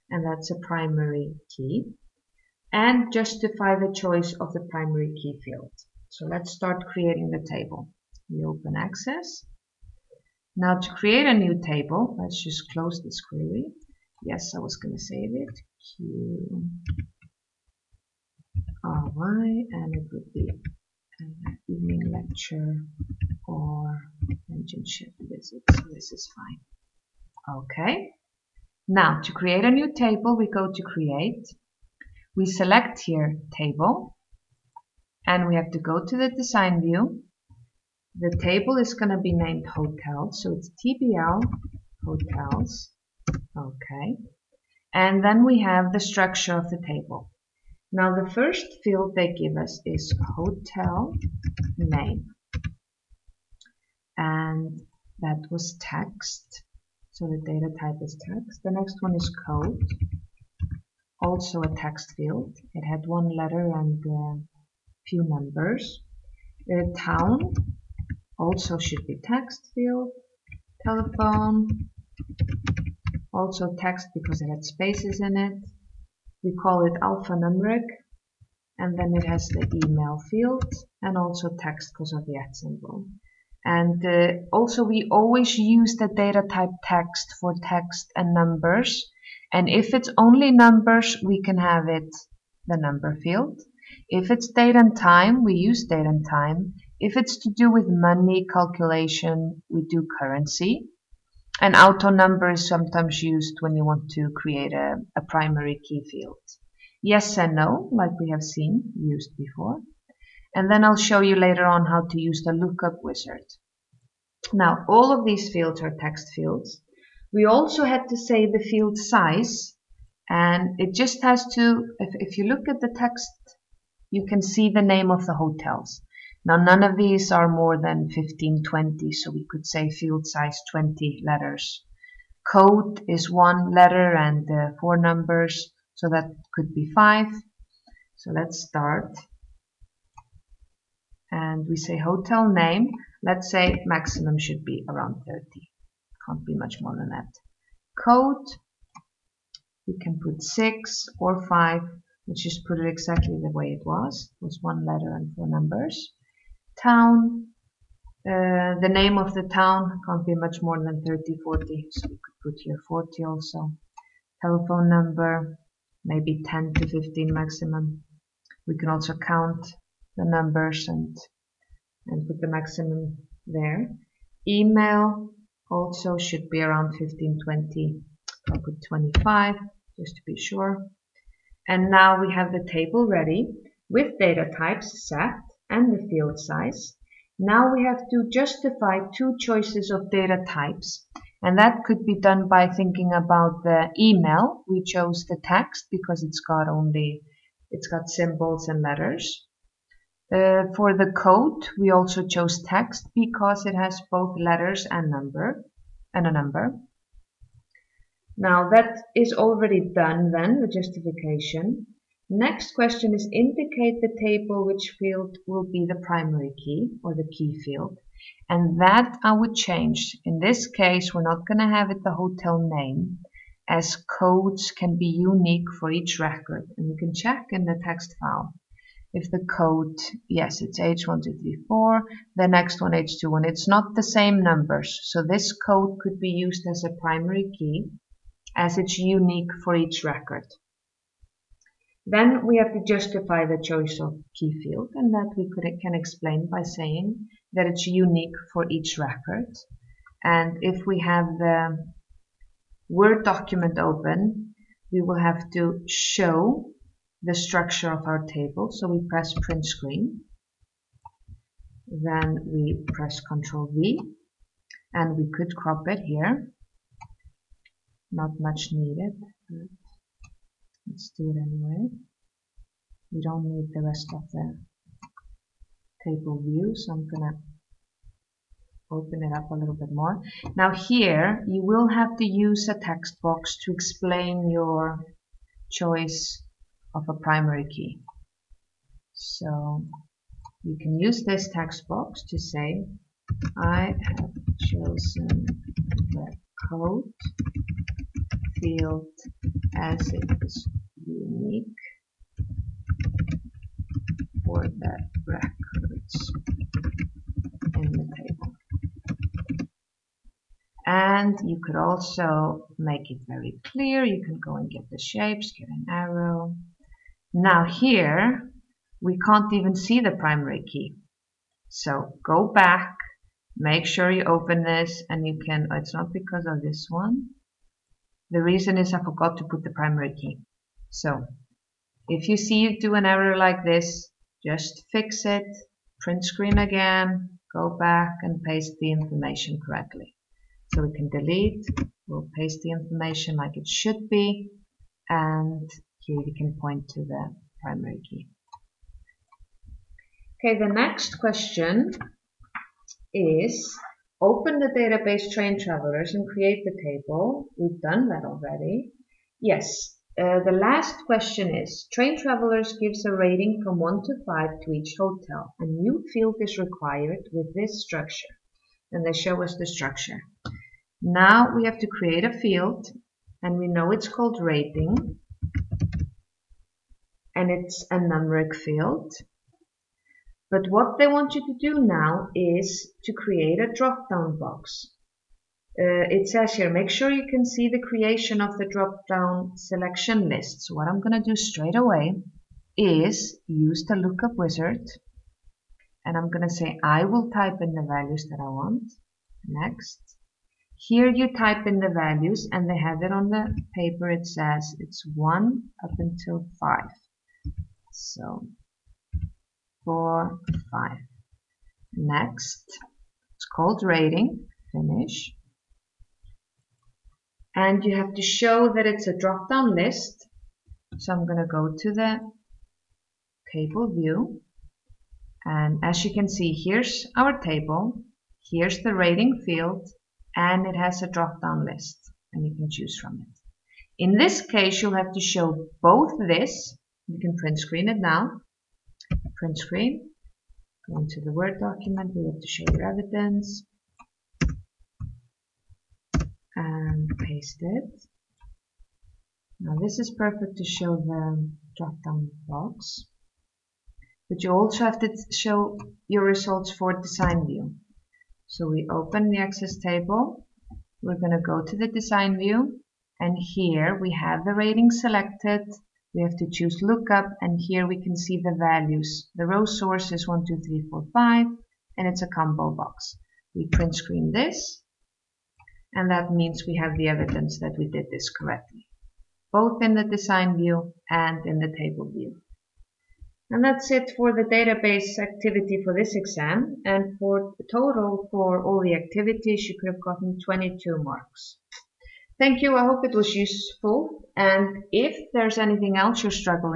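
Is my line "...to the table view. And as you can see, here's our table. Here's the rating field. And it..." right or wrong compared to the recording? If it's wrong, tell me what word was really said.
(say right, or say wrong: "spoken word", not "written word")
right.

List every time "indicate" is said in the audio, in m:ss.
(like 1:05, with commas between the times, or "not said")
3:33.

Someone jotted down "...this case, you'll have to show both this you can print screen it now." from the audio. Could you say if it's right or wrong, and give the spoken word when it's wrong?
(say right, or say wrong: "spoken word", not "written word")
right.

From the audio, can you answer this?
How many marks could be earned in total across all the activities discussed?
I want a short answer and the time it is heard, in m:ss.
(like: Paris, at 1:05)
22, at 8:10.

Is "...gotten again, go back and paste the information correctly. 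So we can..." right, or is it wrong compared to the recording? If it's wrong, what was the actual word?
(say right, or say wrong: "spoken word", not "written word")
wrong: "screen", not "gotten".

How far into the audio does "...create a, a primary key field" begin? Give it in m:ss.
1:44.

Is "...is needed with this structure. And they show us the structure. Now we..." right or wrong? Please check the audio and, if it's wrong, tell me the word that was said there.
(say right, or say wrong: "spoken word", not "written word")
wrong: "required", not "needed".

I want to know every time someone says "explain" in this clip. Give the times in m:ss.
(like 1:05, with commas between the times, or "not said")
4:05, 4:43.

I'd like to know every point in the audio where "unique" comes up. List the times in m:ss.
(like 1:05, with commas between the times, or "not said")
3:45, 3:58, 4:07, 5:01.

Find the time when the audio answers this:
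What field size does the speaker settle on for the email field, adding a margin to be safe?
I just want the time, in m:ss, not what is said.
2:58.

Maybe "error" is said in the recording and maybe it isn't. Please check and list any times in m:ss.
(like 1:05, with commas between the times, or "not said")
5:33.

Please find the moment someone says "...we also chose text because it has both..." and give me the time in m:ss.
3:21.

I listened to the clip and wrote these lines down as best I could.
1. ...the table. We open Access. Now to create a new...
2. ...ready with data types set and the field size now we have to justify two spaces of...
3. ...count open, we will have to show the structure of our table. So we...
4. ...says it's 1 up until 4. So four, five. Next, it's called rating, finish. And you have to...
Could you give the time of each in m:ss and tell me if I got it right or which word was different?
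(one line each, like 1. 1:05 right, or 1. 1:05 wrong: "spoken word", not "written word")
1. 0:07 right
2. 3:03 wrong: "choices", not "spaces"
3. 4:13 wrong: "document", not "count"
4. 6:44 wrong: "5", not "4".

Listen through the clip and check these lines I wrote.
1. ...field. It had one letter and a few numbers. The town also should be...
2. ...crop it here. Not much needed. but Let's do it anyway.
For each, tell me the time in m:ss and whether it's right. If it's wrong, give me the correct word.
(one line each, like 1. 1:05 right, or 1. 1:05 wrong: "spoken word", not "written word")
1. 1:02 right
2. 4:25 right.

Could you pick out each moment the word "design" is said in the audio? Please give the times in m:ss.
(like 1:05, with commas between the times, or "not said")
0:36, 7:36, 7:41, 8:00.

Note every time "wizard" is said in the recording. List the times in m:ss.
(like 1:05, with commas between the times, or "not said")
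1:53, 6:34.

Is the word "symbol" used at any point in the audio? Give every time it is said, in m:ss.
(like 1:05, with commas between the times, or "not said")
1:22, 3:18.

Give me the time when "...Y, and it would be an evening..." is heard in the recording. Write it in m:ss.
0:19.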